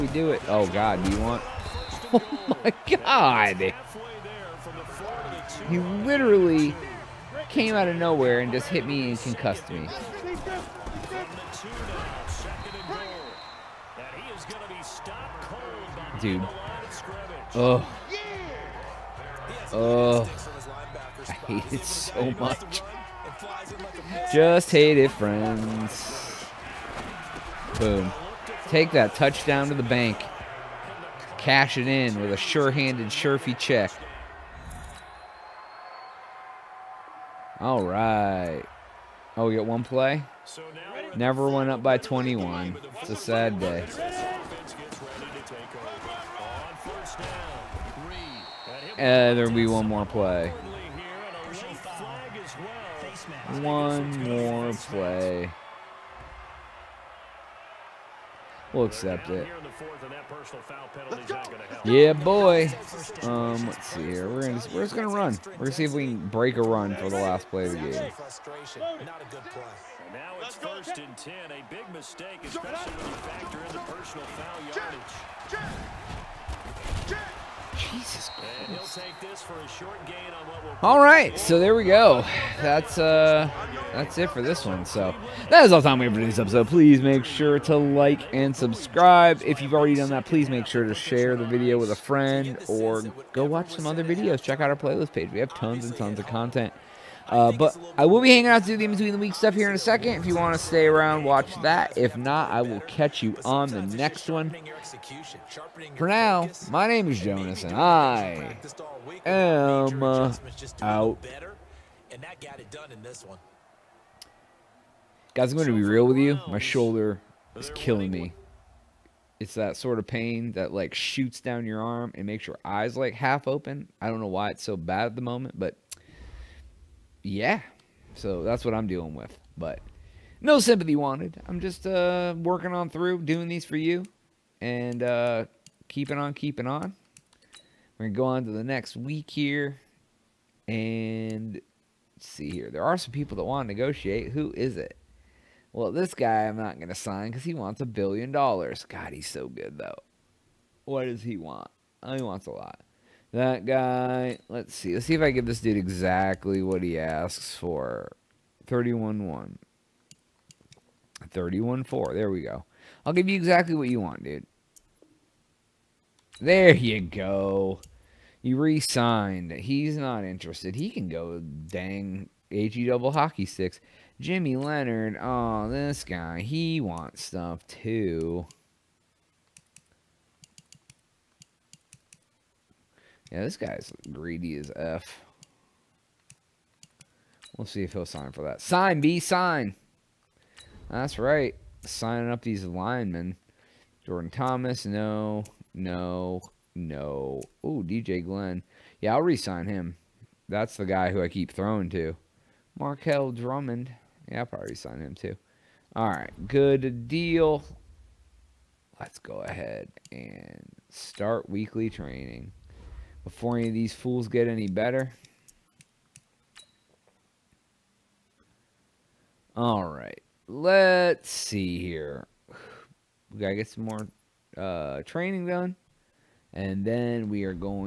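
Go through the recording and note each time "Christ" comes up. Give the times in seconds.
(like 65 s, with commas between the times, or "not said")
78 s.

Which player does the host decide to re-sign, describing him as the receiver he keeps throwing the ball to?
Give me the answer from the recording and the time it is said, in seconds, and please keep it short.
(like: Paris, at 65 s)
DJ Glenn, at 197 s.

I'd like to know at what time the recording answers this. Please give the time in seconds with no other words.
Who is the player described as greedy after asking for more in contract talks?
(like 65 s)
174 s.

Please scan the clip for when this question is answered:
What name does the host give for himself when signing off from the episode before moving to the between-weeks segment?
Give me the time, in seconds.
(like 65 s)
107 s.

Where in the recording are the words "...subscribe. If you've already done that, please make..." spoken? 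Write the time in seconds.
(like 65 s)
88 s.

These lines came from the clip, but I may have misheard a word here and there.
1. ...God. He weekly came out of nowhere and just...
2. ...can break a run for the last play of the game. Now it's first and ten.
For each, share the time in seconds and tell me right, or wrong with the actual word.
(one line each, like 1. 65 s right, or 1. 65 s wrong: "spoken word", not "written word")
1. 2 s wrong: "literally", not "weekly"
2. 66 s right.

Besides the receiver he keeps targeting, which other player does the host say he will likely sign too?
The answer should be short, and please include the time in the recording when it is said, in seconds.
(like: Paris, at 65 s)
Markel Drummond, at 202 s.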